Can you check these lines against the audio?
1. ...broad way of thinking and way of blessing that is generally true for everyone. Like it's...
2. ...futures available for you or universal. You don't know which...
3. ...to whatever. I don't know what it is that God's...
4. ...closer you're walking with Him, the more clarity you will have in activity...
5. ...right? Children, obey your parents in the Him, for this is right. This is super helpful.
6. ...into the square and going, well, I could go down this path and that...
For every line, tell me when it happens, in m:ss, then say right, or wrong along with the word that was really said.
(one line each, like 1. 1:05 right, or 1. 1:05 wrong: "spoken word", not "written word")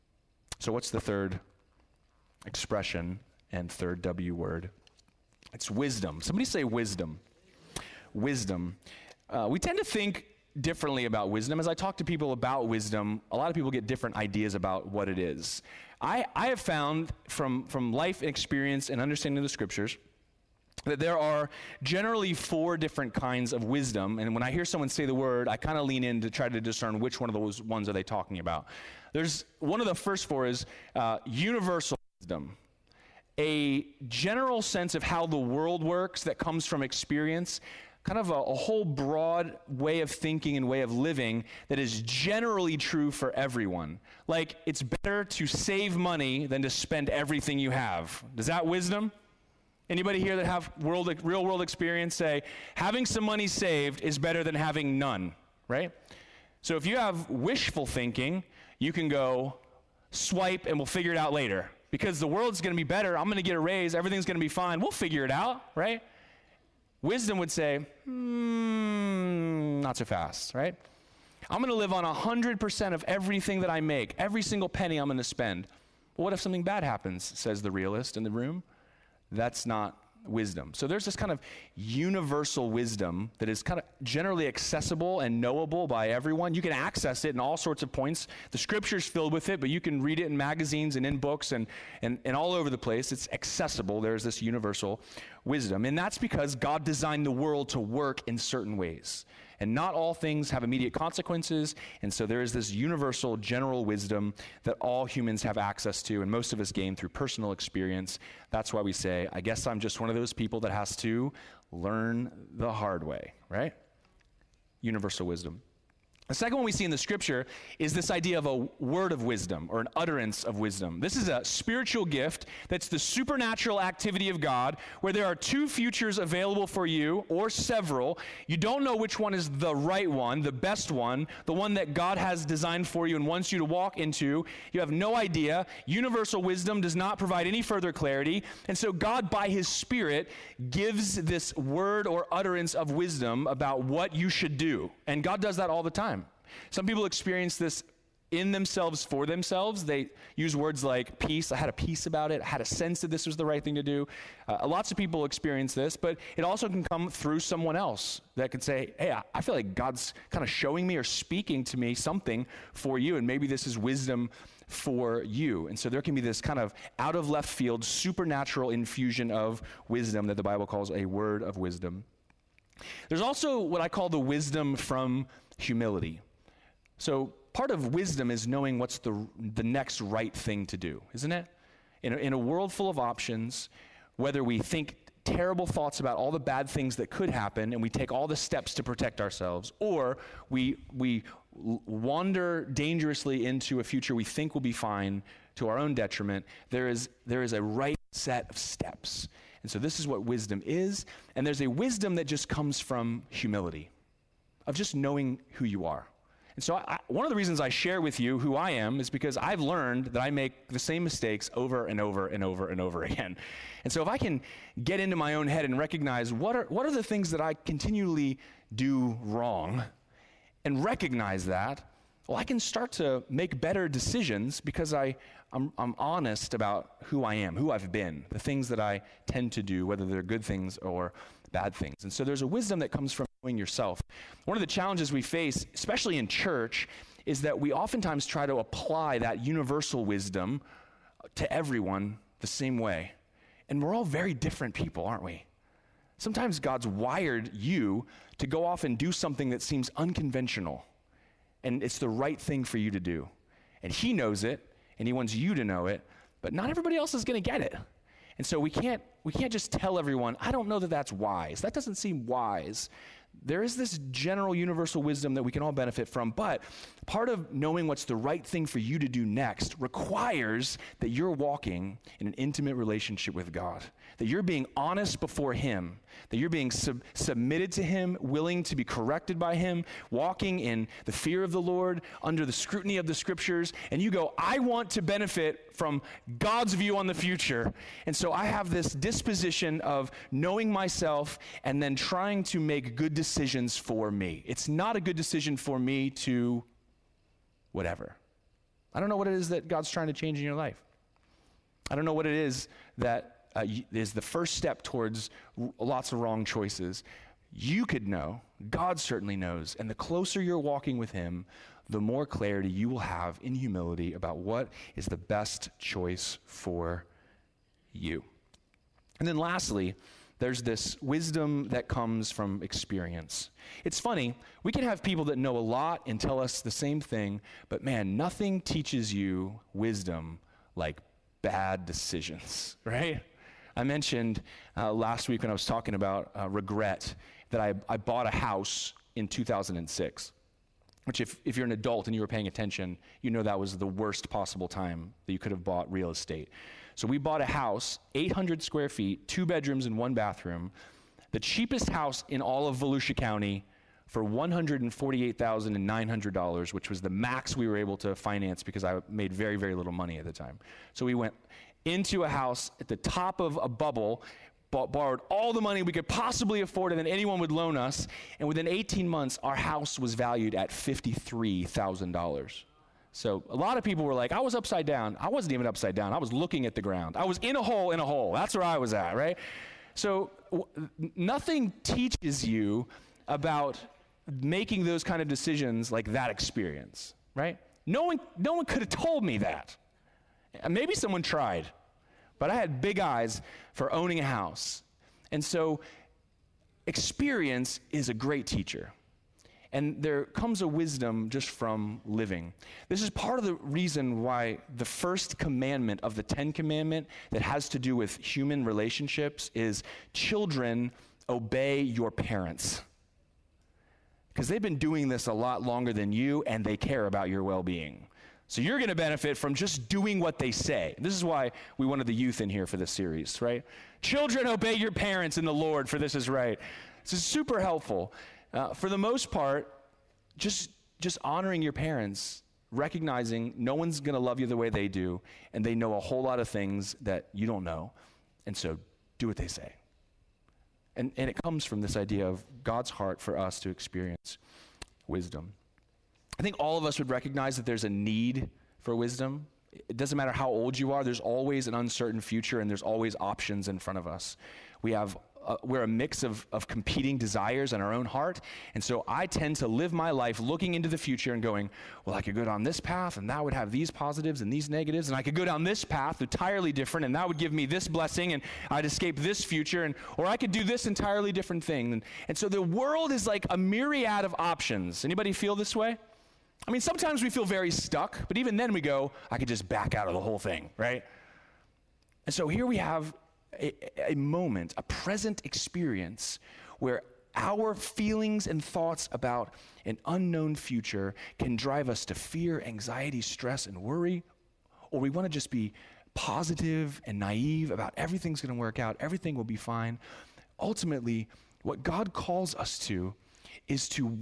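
1. 0:38 wrong: "living", not "blessing"
2. 2:05 wrong: "several", not "universal"
3. 4:56 right
4. 5:09 wrong: "humility", not "activity"
5. 7:03 wrong: "Lord", not "Him"
6. 7:40 wrong: "future", not "square".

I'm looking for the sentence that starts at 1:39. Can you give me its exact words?
And not all things have immediate consequences.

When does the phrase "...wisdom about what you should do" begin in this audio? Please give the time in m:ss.
2:22.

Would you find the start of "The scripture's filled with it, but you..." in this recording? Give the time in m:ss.
1:28.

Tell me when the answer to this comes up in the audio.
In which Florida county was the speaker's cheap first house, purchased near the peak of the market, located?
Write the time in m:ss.
5:52.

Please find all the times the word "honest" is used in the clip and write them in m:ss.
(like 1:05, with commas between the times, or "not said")
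3:45, 4:34.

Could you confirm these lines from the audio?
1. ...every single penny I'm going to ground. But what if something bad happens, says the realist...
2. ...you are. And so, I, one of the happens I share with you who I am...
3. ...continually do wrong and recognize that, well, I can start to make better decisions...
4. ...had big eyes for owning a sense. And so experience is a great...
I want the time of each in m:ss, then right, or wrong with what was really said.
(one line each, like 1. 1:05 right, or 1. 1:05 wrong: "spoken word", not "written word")
1. 1:14 wrong: "spend", not "ground"
2. 3:25 wrong: "reasons", not "happens"
3. 3:37 right
4. 6:32 wrong: "house", not "sense".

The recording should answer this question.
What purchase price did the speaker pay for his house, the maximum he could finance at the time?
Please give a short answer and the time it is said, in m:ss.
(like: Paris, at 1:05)
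$148,900, at 5:54.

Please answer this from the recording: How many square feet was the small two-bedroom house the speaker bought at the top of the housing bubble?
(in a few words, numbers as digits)
800.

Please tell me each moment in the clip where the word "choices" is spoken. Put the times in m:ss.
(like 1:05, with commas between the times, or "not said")
5:06, 5:15.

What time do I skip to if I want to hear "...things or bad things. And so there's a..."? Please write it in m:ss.
3:50.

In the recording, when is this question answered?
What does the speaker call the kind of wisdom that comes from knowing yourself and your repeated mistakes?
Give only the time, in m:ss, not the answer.
2:54.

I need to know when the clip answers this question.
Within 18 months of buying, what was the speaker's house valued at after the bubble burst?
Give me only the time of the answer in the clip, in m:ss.
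6:10.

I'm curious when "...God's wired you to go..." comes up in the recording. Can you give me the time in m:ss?
4:06.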